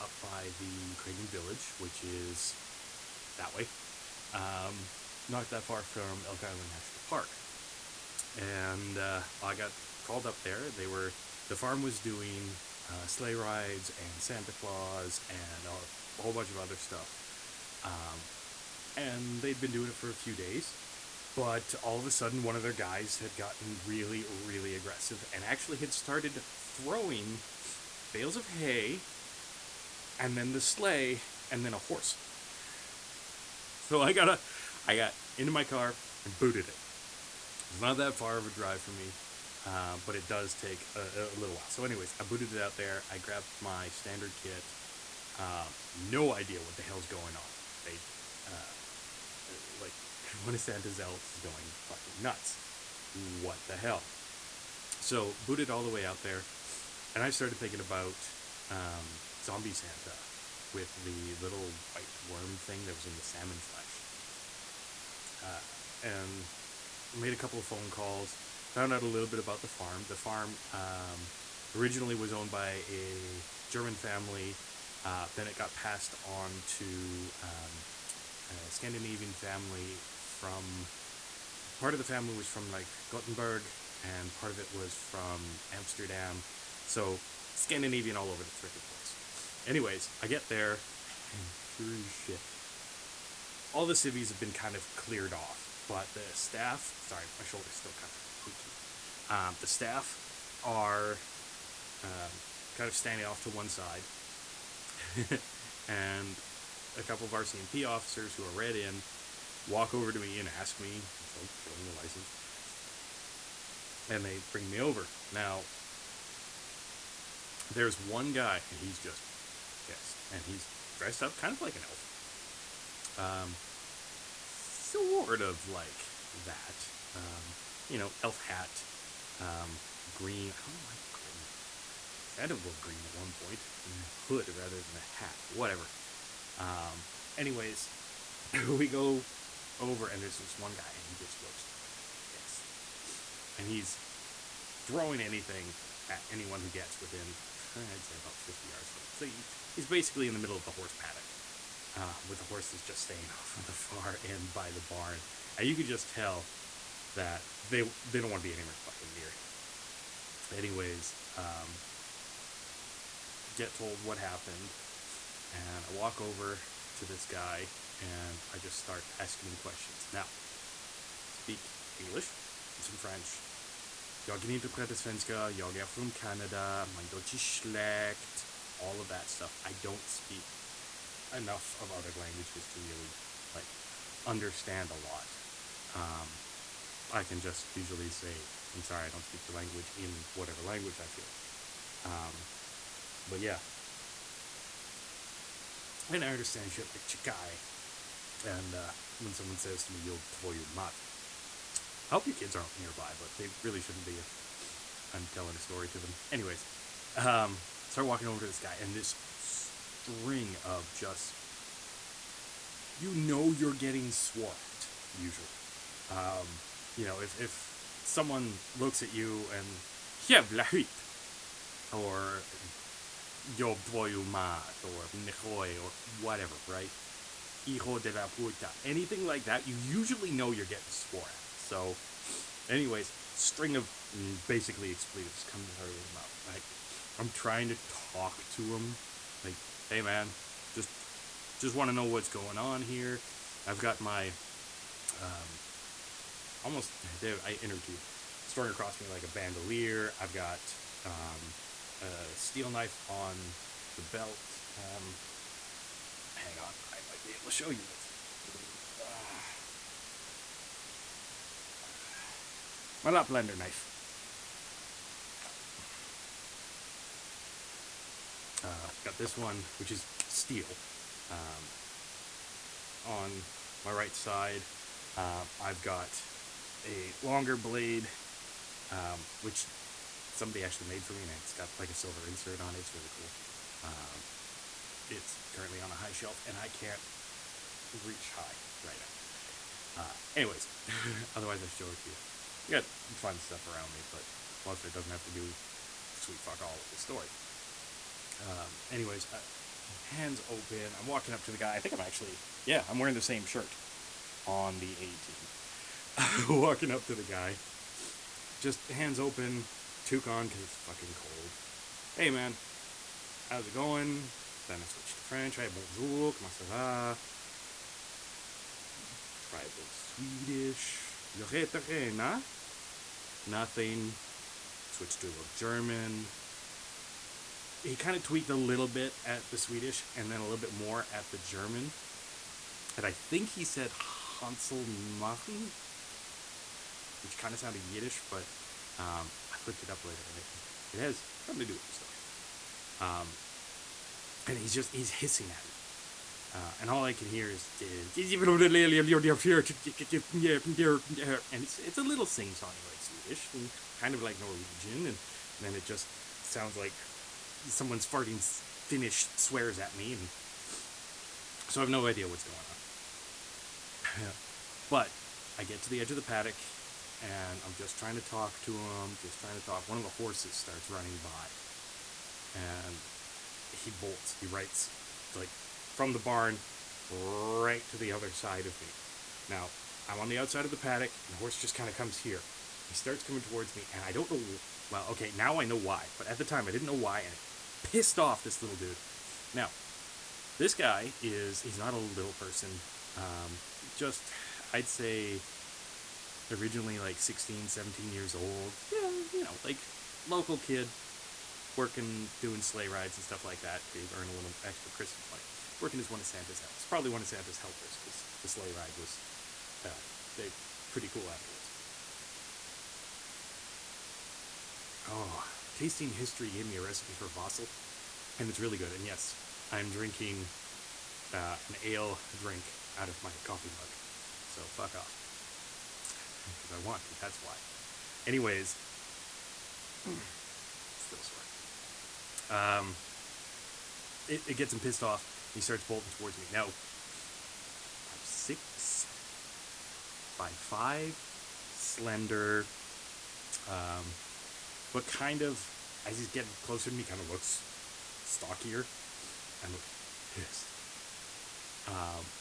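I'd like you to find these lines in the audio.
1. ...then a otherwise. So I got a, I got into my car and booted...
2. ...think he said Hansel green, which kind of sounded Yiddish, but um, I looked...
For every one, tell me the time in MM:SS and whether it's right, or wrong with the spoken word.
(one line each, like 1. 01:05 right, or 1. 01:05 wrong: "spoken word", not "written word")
1. 00:31 wrong: "horse", not "otherwise"
2. 05:33 wrong: "machen", not "green".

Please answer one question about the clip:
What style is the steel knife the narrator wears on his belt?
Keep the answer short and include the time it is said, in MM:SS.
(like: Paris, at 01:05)
Laplander knife, at 04:23.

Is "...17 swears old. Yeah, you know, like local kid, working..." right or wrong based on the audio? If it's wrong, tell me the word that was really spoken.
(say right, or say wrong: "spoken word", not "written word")
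wrong: "years", not "swears".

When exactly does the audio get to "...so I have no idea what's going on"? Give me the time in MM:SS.
06:01.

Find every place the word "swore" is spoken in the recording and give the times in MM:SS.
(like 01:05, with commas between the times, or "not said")
03:34, 03:50.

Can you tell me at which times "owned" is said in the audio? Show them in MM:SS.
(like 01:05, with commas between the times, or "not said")
01:12.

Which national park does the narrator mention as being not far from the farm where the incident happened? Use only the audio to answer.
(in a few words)
Elk Island National Park.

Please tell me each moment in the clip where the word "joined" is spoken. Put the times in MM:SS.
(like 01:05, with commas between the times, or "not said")
not said.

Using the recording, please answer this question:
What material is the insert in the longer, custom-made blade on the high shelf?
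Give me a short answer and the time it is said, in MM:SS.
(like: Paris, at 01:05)
silver, at 04:41.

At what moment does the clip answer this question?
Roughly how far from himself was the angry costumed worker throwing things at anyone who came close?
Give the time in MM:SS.
02:28.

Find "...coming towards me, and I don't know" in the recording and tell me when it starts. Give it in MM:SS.
06:23.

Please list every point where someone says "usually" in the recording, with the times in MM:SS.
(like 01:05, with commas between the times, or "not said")
03:07, 03:35, 03:49.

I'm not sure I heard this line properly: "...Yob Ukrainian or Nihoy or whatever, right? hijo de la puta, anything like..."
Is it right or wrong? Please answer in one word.
wrong.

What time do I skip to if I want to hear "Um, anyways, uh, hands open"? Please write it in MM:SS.
04:58.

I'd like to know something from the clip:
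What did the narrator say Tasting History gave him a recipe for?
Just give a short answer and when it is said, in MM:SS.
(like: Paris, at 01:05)
Vossel, at 06:57.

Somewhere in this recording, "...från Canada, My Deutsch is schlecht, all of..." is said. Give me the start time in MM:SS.
02:55.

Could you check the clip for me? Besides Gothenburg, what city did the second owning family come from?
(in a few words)
Amsterdam.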